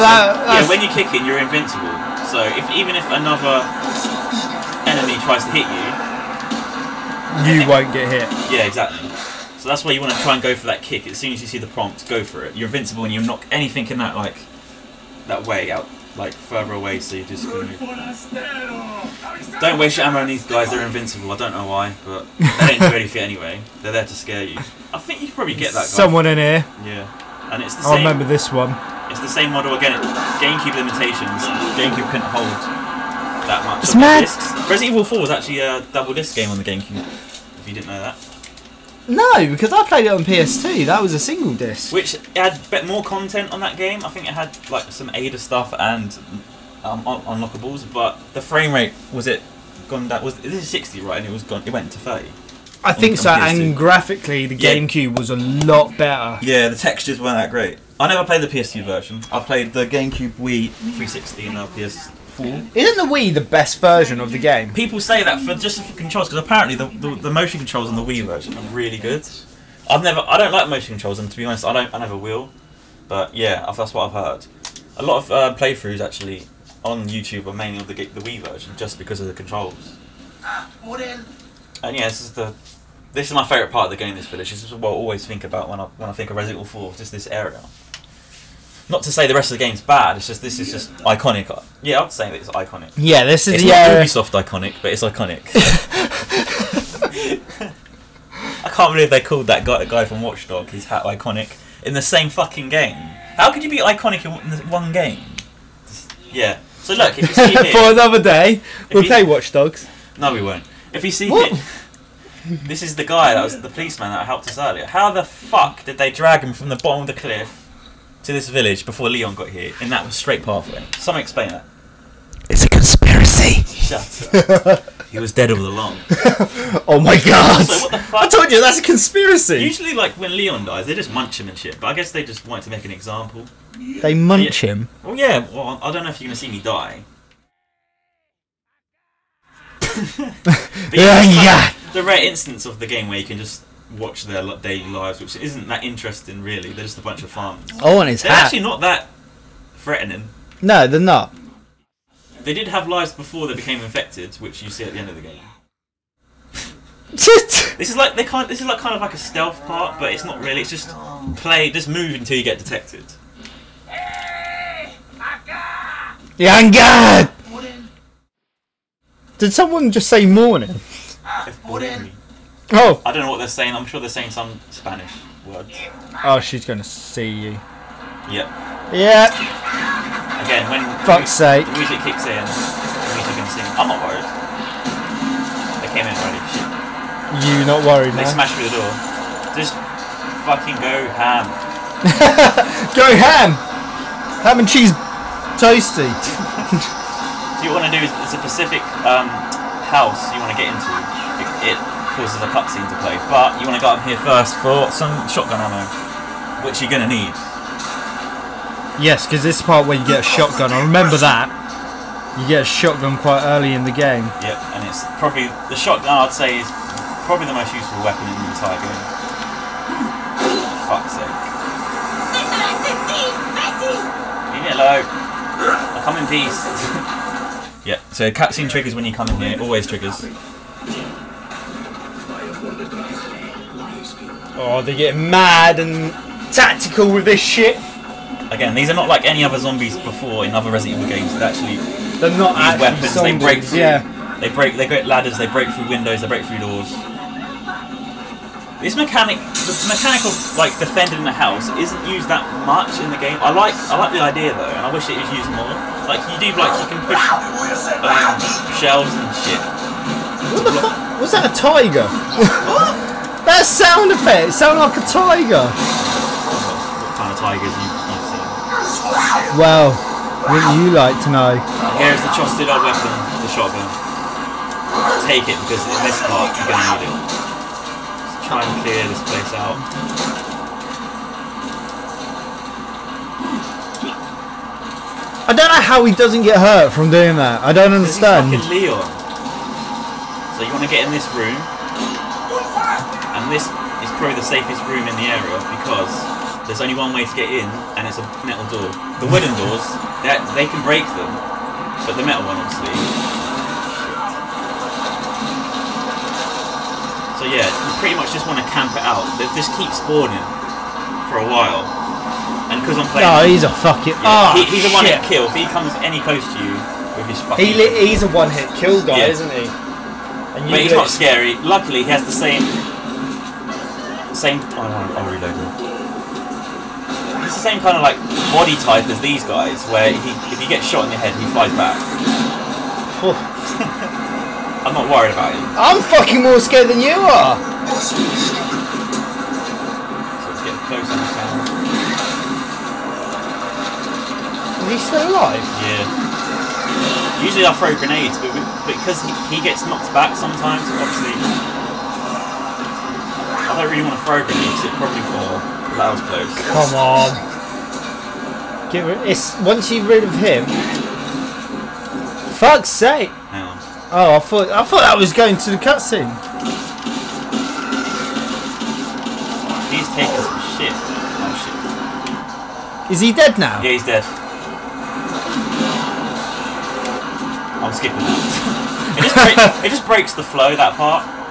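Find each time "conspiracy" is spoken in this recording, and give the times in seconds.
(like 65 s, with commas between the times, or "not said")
122 s, 128 s.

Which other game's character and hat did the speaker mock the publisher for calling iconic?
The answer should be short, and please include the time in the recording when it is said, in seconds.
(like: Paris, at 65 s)
Watch Dogs, at 100 s.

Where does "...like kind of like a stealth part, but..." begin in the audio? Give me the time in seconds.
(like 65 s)
158 s.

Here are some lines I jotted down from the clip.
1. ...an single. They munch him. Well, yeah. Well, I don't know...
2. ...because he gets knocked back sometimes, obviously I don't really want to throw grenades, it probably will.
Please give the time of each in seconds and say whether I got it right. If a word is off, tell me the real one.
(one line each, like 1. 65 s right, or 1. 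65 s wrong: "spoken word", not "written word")
1. 132 s wrong: "example", not "single"
2. 348 s right.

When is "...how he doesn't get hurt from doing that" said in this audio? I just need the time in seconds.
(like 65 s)
285 s.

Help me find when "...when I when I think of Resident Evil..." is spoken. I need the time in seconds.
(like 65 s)
85 s.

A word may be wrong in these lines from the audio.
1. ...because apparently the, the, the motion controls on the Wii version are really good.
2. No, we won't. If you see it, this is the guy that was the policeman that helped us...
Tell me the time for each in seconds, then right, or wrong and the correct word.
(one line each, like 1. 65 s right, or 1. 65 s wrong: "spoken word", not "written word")
1. 66 s right
2. 110 s right.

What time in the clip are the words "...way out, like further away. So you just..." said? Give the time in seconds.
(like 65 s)
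15 s.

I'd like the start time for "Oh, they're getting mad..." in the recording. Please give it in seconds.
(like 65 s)
234 s.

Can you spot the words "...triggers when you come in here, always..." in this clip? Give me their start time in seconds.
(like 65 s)
228 s.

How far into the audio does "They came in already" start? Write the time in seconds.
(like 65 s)
185 s.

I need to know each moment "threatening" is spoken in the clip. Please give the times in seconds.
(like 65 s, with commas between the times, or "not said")
149 s.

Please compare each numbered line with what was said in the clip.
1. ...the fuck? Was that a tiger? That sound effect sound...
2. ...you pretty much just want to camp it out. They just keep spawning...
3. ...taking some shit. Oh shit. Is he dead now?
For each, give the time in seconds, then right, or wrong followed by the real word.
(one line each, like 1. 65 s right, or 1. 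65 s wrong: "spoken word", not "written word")
1. 260 s right
2. 307 s right
3. 370 s right.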